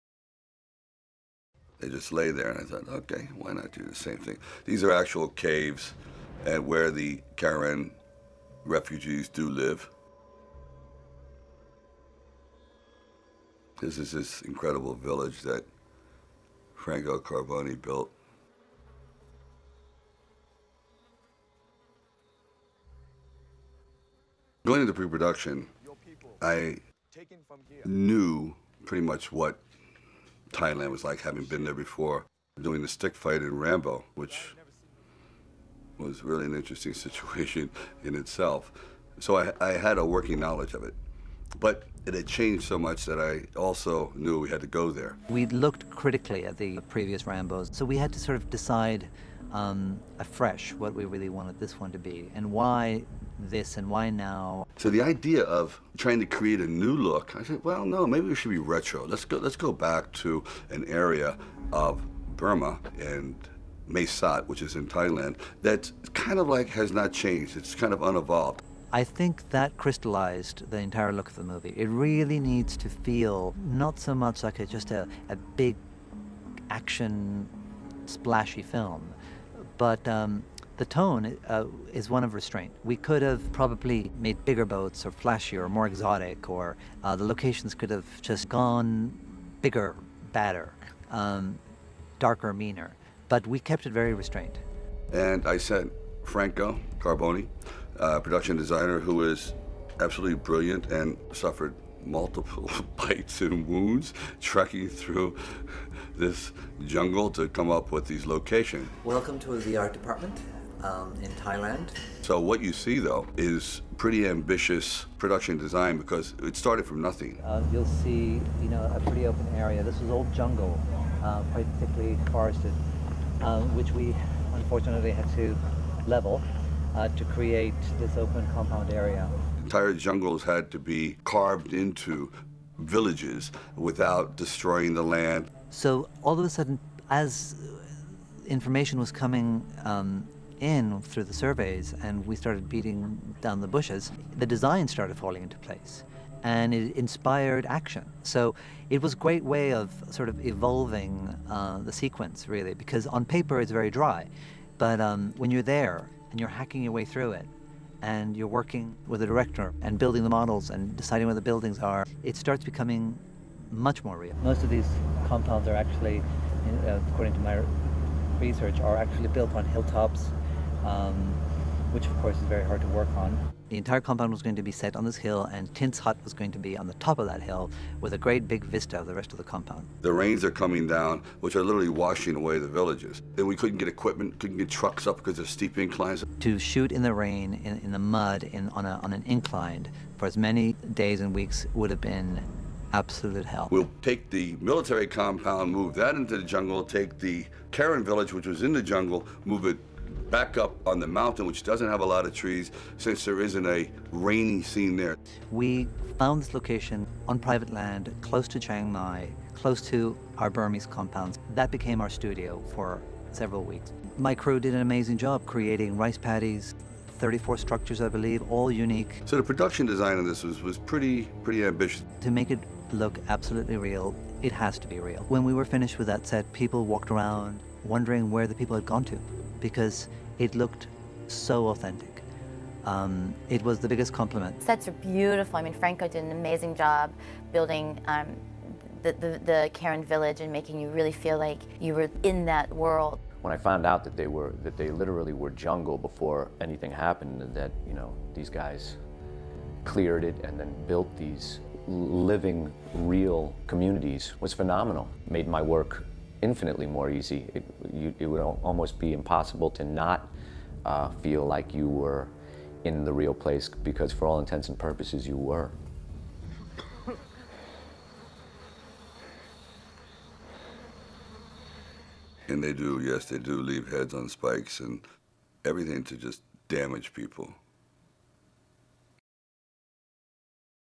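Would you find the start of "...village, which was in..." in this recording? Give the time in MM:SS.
03:18.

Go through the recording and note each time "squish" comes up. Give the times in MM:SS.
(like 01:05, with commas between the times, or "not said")
not said.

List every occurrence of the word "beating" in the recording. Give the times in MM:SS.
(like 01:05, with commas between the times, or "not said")
02:22.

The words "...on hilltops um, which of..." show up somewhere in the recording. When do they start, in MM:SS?
02:49.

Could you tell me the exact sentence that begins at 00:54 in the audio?
So the idea of trying to create a new look, I said, well, no, maybe we should be retro.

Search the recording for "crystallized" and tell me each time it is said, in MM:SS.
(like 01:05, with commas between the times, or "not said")
01:09.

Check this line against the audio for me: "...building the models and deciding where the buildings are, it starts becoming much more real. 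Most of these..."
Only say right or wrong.
right.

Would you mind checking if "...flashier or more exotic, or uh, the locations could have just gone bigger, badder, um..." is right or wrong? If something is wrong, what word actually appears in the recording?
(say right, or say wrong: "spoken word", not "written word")
right.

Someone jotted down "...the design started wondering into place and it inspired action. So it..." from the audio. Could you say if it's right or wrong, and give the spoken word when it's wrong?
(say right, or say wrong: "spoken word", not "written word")
wrong: "falling", not "wondering".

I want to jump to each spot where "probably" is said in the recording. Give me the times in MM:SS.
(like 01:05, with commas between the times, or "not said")
01:23.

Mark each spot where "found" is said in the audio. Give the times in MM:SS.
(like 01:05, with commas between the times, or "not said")
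03:26, 04:03.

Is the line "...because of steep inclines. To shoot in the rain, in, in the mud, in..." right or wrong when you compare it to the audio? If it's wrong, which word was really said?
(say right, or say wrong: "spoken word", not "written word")
right.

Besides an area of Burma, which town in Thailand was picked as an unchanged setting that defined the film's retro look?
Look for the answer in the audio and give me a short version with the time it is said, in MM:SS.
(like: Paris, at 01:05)
Mae Sot, at 01:03.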